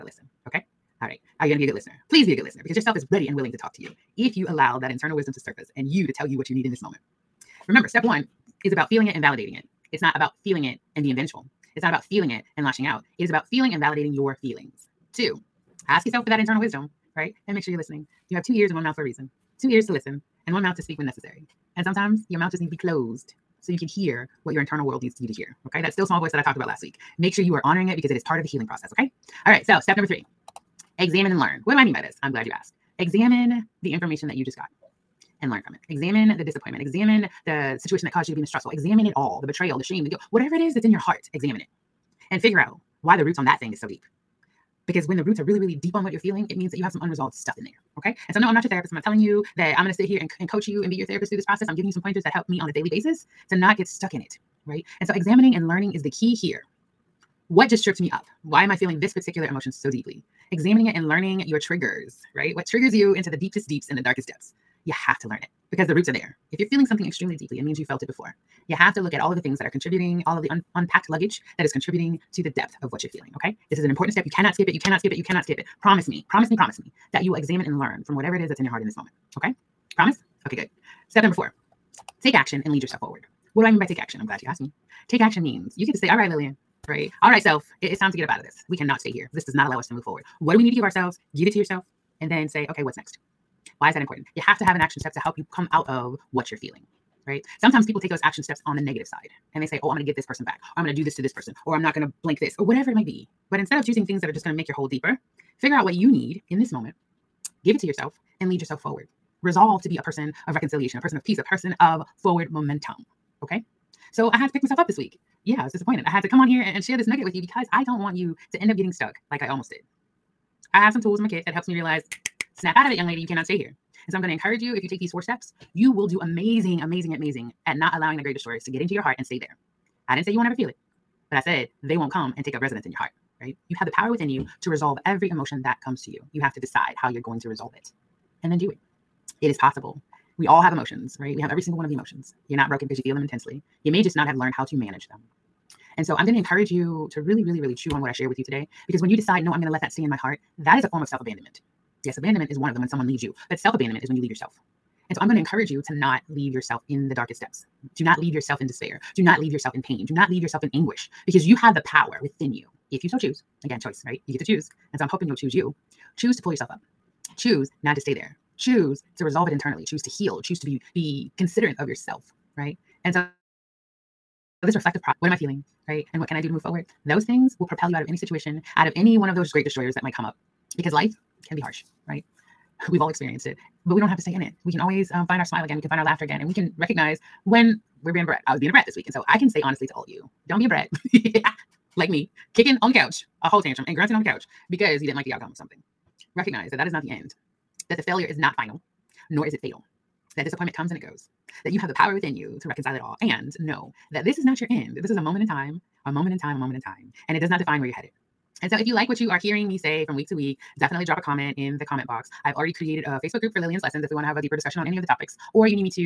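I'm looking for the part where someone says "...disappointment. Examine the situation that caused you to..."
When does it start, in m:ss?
0:36.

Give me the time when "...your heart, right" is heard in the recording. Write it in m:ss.
2:12.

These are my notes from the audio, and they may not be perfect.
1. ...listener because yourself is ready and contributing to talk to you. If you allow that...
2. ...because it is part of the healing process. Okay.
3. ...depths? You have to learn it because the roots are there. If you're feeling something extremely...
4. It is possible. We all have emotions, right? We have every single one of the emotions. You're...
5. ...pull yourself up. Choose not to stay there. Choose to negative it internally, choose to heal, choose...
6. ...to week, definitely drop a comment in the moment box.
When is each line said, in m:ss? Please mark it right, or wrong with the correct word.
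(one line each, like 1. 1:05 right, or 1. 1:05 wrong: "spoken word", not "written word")
1. 0:02 wrong: "willing", not "contributing"
2. 0:27 right
3. 1:04 right
4. 2:19 right
5. 2:46 wrong: "resolve", not "negative"
6. 3:30 wrong: "comment", not "moment".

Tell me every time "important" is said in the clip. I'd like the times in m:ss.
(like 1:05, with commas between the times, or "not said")
1:13, 1:34.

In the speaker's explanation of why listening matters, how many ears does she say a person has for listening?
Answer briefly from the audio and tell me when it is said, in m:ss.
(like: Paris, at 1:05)
2, at 0:19.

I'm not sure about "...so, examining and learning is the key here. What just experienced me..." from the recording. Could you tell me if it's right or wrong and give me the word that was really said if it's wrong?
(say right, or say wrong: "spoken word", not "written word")
wrong: "tripped", not "experienced".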